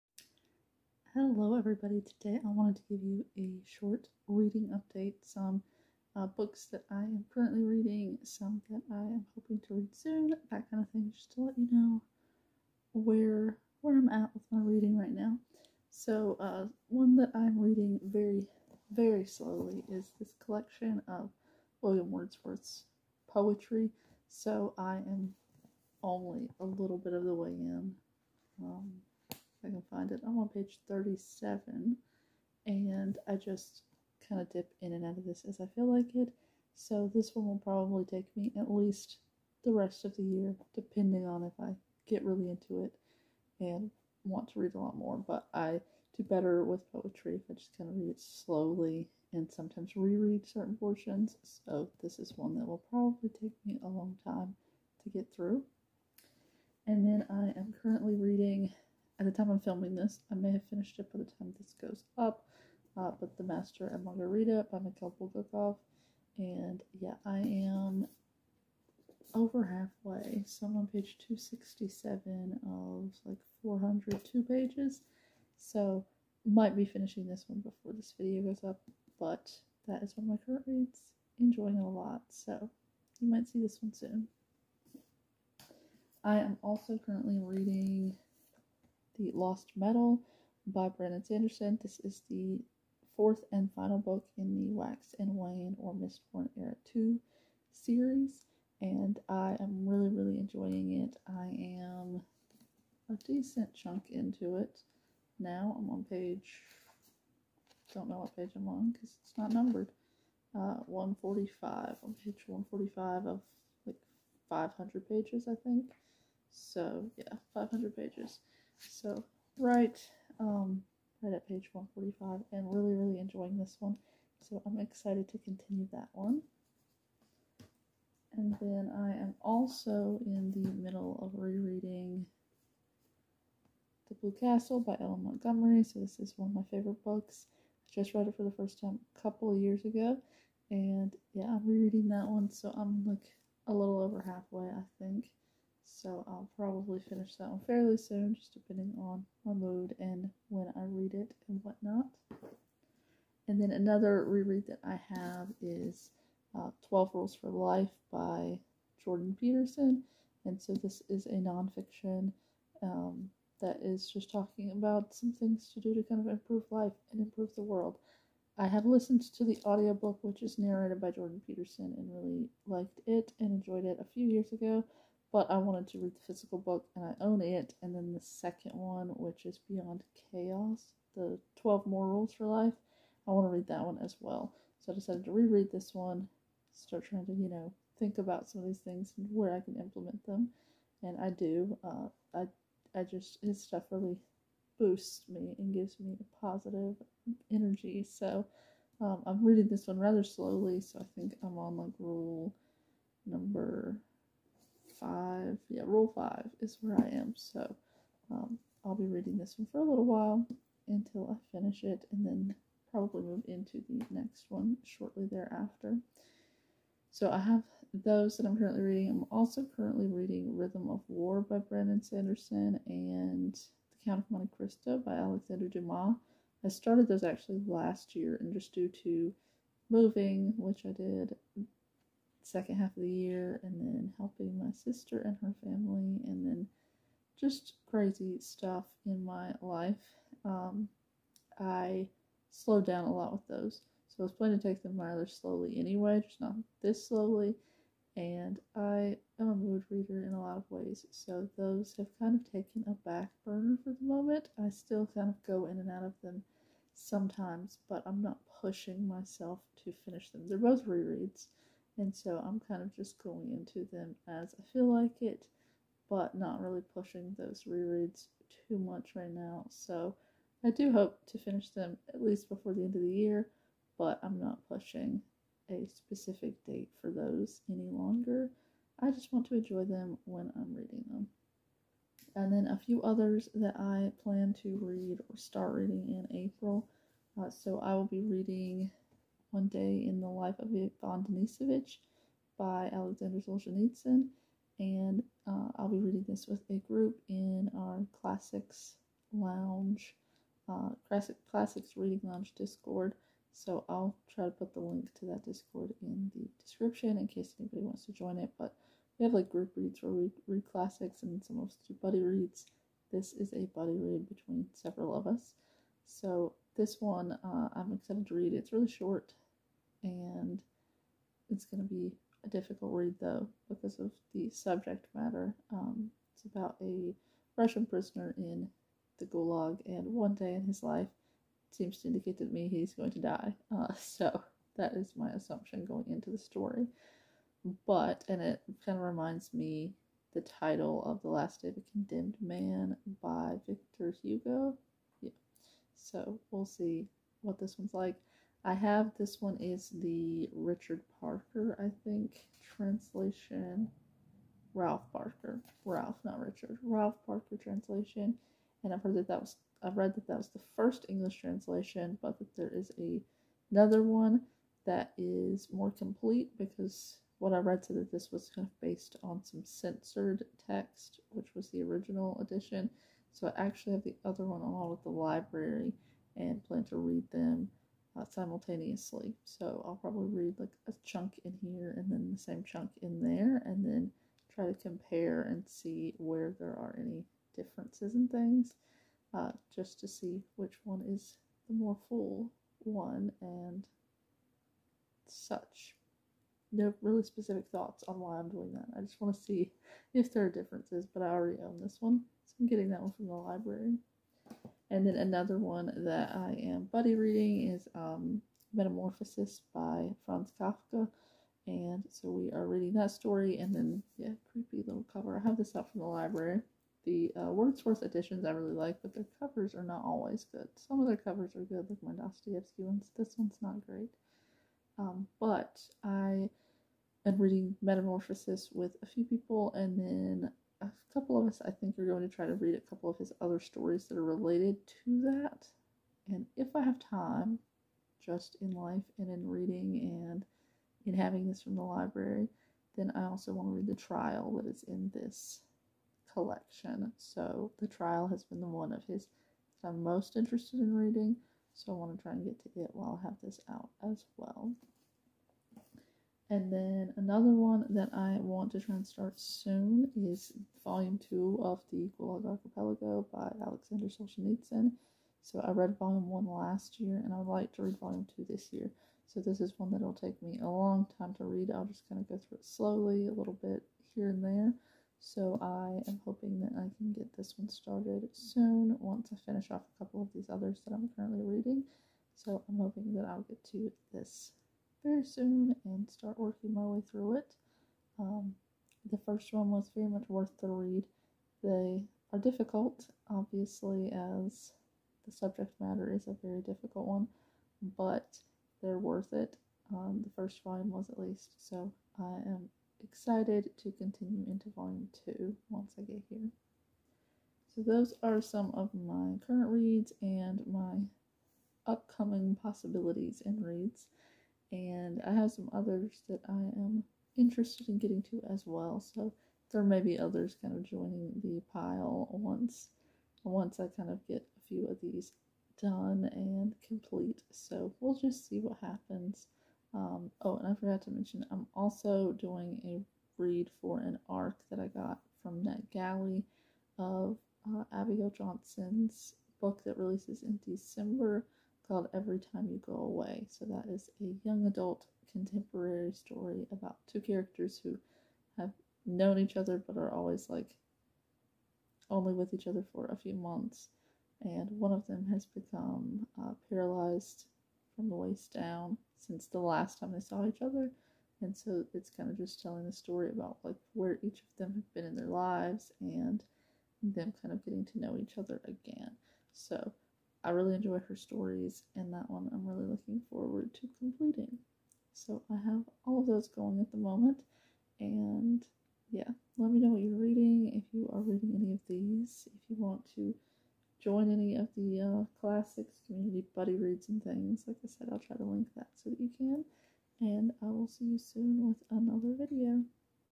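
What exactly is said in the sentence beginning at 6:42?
So I'm getting that one from the library.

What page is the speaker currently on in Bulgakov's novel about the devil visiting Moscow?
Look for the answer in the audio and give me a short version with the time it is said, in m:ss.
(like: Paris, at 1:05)
267, at 1:10.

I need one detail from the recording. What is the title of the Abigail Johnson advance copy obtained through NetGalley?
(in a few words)
Every Time You Go Away.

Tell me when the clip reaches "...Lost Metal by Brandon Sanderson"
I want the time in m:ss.
1:29.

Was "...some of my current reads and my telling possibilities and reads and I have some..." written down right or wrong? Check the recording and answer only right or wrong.
wrong.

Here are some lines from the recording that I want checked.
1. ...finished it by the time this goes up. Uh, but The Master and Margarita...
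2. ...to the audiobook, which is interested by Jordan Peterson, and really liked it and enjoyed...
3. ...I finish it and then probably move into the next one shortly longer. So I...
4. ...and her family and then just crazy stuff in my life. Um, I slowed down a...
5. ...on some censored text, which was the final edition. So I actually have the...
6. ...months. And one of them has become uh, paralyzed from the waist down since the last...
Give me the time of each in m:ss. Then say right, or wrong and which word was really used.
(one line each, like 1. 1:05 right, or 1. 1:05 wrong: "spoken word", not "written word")
1. 1:00 right
2. 2:49 wrong: "narrated", not "interested"
3. 3:31 wrong: "thereafter", not "longer"
4. 3:55 right
5. 6:09 wrong: "original", not "final"
6. 9:13 right.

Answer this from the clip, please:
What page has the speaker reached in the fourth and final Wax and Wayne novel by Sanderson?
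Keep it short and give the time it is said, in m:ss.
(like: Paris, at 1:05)
145, at 1:52.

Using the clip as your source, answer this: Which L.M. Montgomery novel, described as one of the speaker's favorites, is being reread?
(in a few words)
The Blue Castle.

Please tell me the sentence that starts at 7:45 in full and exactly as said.
So I read Volume 1 last year and I would like to read Volume 2 this year.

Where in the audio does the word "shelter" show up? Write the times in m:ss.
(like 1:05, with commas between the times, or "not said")
not said.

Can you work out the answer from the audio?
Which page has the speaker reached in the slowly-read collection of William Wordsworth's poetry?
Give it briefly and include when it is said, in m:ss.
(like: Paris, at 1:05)
37, at 0:30.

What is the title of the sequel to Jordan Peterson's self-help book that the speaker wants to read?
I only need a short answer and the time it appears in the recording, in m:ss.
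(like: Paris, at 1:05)
Beyond Chaos, at 2:59.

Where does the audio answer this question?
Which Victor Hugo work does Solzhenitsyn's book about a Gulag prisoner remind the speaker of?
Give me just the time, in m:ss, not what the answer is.
5:41.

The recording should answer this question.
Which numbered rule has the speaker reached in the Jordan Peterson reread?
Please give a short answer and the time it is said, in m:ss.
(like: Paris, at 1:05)
Rule 5, at 3:25.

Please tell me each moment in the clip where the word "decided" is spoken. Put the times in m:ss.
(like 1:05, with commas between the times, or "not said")
3:04.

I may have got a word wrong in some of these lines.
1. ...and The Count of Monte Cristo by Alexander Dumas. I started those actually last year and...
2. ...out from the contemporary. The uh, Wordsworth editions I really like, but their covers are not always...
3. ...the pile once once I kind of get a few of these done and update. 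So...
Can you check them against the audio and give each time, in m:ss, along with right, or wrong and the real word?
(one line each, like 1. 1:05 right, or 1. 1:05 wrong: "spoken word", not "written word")
1. 3:42 right
2. 6:55 wrong: "library", not "contemporary"
3. 8:41 wrong: "complete", not "update".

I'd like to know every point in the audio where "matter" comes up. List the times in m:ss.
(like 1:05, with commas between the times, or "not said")
5:25, 8:15.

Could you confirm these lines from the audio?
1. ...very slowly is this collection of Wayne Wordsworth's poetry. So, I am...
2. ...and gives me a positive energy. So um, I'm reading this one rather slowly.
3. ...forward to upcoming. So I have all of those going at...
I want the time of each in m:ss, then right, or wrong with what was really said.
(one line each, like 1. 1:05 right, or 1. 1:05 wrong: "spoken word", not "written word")
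1. 0:18 wrong: "William", not "Wayne"
2. 3:15 right
3. 9:33 wrong: "completing", not "upcoming".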